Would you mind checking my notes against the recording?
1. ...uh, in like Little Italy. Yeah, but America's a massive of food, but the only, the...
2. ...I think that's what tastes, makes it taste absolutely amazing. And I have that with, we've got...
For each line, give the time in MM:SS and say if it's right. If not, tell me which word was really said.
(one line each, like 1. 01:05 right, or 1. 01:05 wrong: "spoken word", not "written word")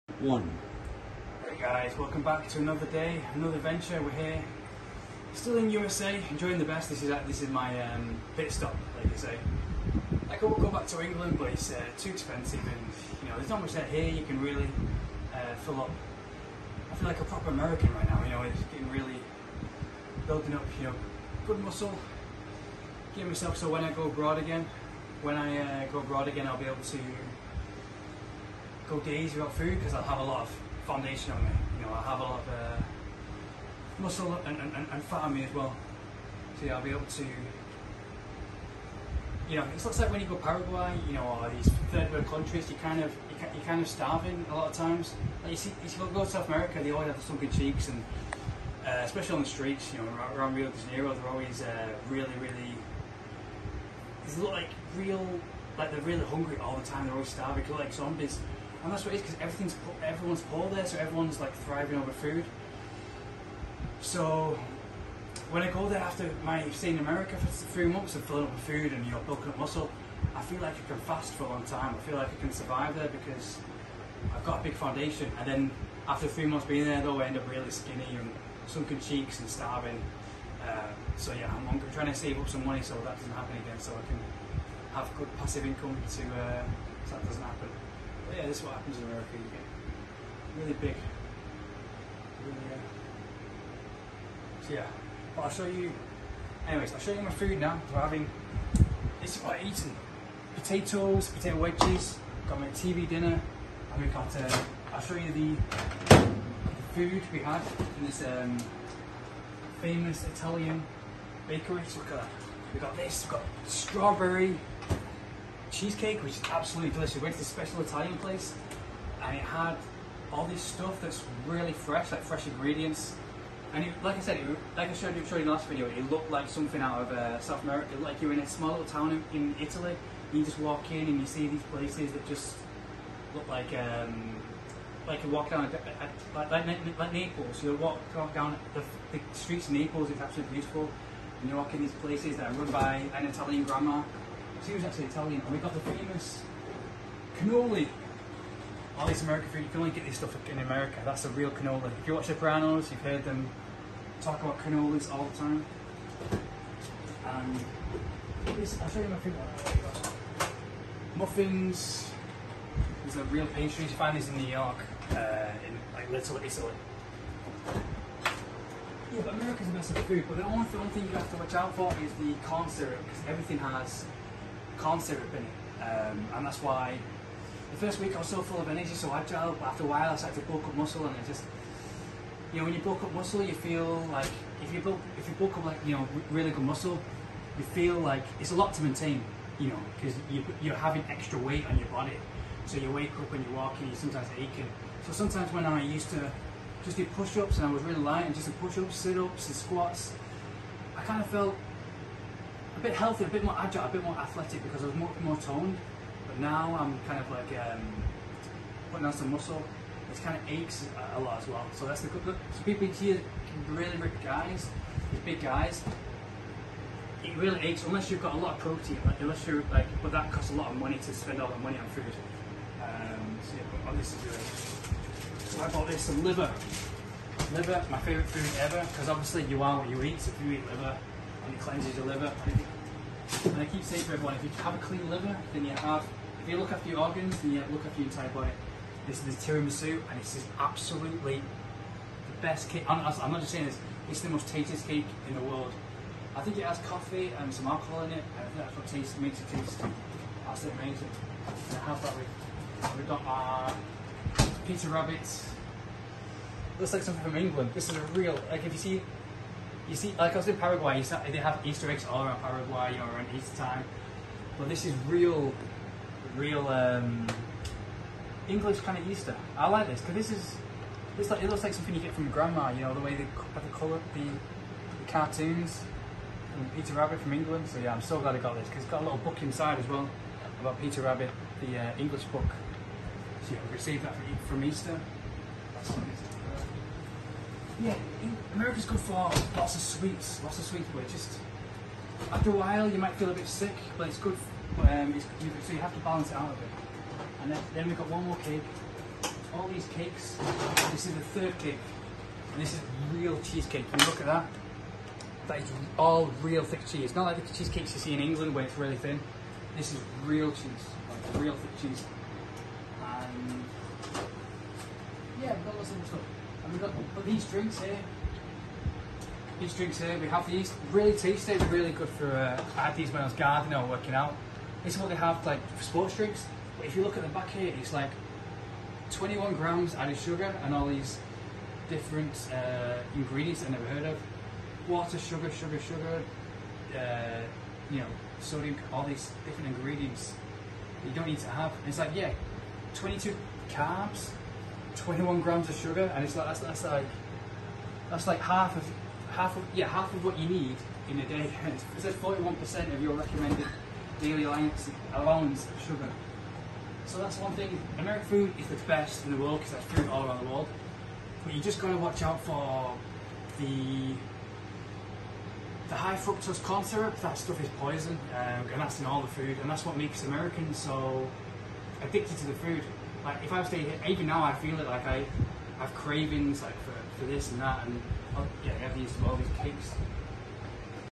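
1. 02:45 right
2. 04:08 right.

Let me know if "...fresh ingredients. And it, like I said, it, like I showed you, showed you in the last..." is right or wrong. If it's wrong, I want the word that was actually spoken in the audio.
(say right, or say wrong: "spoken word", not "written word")
right.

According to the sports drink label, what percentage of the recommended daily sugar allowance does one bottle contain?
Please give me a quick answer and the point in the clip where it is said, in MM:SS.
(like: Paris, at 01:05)
41%, at 05:52.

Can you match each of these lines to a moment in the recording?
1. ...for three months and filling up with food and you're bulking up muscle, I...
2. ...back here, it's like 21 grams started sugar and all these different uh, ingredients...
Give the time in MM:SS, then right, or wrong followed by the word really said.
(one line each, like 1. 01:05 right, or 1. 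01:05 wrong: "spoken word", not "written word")
1. 01:07 right
2. 05:27 wrong: "added", not "started".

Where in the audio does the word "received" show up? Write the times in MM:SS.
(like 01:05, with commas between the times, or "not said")
04:43.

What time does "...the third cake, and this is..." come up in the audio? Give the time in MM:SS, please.
05:01.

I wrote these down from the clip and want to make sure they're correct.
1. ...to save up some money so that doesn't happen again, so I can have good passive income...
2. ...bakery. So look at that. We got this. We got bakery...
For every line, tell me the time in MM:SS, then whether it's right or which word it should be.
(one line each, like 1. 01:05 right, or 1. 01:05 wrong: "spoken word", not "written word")
1. 01:22 right
2. 01:51 wrong: "strawberry", not "bakery".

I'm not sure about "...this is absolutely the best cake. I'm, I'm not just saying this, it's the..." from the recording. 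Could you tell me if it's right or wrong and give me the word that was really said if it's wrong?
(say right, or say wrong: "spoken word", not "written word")
right.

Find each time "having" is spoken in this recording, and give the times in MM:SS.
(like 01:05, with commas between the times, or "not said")
01:37, 03:10.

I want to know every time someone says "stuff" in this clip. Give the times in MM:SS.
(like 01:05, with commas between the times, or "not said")
02:00, 02:30, 05:16, 06:07.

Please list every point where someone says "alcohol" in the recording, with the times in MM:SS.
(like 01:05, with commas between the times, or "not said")
04:07.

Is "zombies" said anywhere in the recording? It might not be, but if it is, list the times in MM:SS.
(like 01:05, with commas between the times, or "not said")
00:57.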